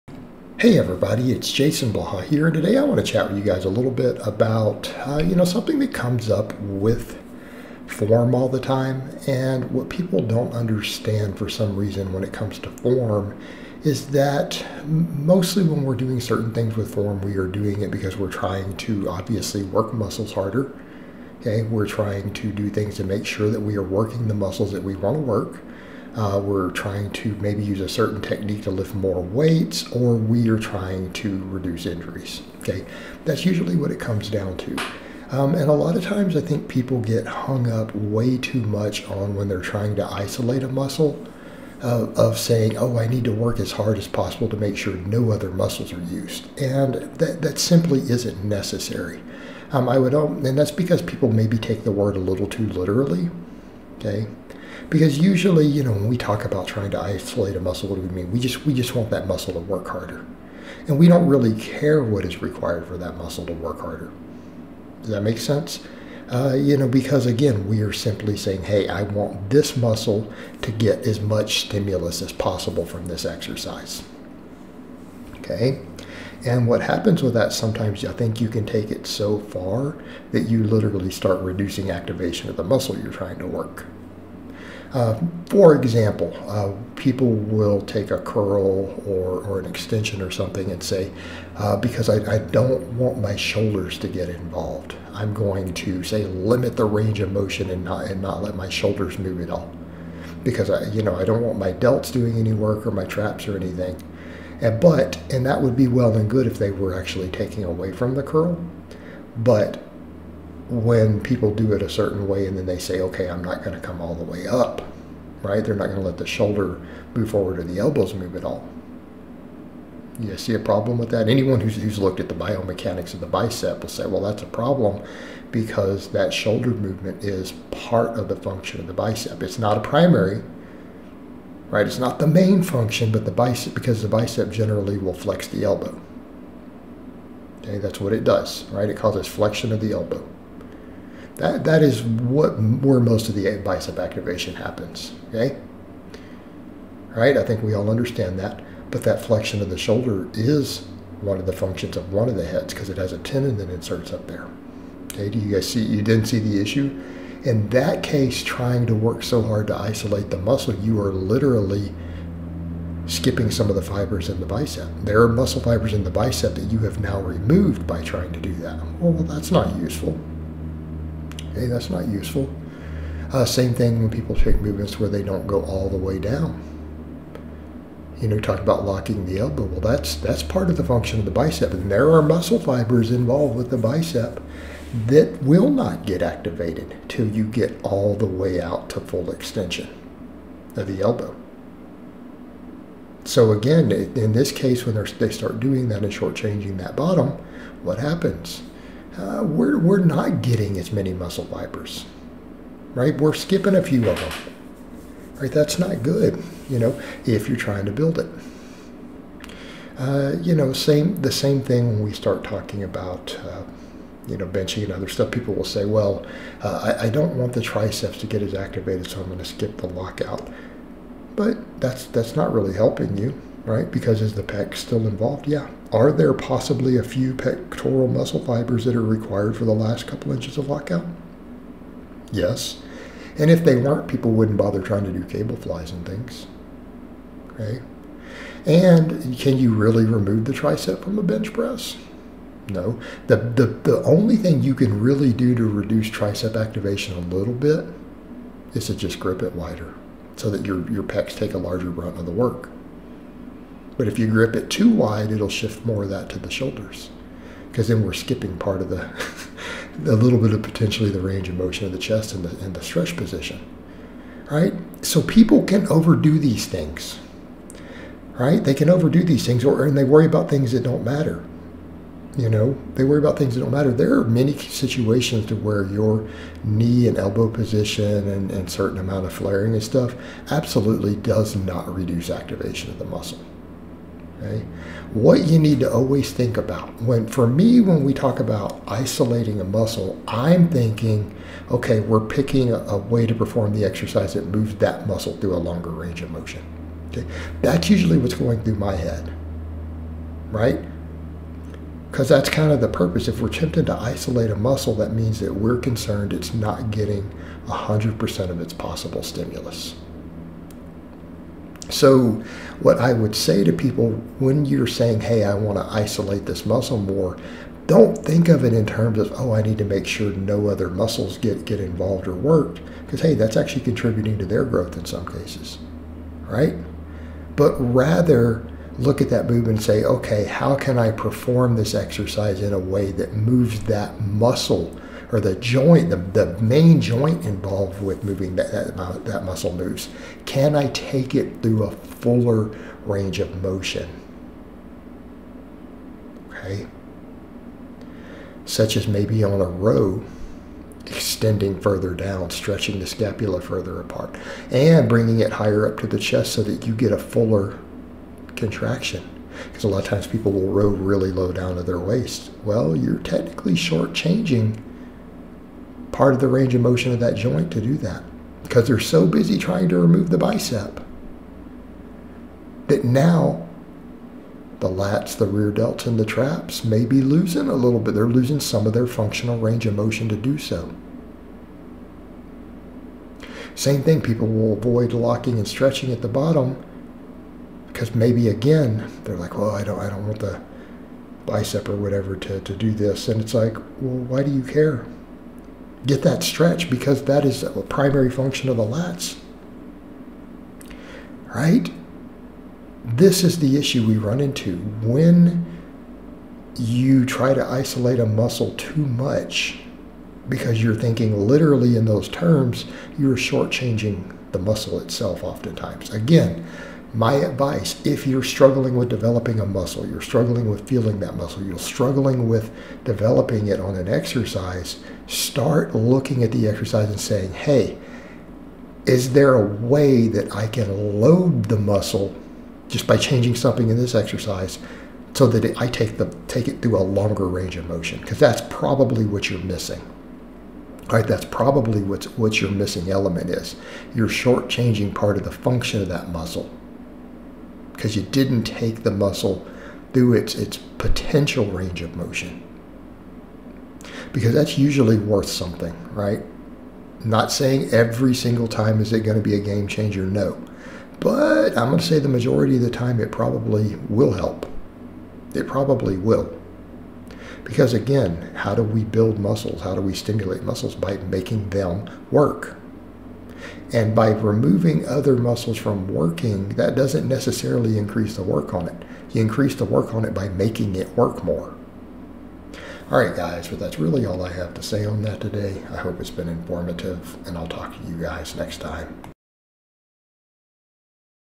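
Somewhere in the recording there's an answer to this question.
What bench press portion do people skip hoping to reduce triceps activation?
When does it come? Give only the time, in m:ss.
3:39.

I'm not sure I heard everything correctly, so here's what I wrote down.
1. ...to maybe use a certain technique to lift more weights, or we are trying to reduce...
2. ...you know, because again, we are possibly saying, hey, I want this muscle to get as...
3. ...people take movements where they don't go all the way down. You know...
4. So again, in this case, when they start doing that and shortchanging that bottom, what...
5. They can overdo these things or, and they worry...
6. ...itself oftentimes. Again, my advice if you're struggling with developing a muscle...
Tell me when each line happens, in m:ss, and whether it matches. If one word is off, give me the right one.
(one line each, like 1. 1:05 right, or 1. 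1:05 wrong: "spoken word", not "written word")
1. 0:27 right
2. 1:06 wrong: "simply", not "possibly"
3. 2:54 right
4. 3:13 right
5. 4:28 right
6. 6:54 right.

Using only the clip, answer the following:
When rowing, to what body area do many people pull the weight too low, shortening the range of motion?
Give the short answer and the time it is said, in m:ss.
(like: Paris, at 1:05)
their waist, at 6:01.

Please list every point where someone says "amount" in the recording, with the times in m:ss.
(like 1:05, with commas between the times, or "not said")
4:38.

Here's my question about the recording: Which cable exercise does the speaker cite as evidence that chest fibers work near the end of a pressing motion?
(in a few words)
cable flies.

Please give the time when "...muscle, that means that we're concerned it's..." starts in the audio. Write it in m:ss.
5:04.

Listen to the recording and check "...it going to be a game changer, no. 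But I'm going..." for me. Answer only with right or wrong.
right.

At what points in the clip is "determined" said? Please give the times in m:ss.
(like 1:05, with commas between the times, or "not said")
not said.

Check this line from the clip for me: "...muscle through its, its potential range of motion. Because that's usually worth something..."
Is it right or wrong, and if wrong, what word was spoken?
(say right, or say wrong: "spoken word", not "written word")
right.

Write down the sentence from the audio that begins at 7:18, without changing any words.
Because that's probably what you're missing.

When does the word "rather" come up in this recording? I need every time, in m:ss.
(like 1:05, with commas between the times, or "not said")
5:27.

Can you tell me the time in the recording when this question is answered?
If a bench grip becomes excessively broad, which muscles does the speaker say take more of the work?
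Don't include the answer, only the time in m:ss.
4:16.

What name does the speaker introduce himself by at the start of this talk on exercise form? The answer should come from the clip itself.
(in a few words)
Jason Blaha.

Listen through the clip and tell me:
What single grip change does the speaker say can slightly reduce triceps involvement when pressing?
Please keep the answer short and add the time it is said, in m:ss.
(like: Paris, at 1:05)
grip it wider, at 4:09.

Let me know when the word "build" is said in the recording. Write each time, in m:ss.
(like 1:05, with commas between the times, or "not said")
3:27, 7:49.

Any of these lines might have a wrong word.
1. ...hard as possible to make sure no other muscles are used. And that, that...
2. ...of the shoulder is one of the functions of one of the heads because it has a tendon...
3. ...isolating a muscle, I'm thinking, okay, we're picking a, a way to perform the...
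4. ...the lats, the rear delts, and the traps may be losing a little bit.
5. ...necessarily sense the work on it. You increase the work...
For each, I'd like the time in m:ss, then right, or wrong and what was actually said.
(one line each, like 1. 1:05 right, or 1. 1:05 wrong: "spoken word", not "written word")
1. 0:43 right
2. 2:29 right
3. 4:48 right
4. 6:14 right
5. 7:57 wrong: "increase", not "sense".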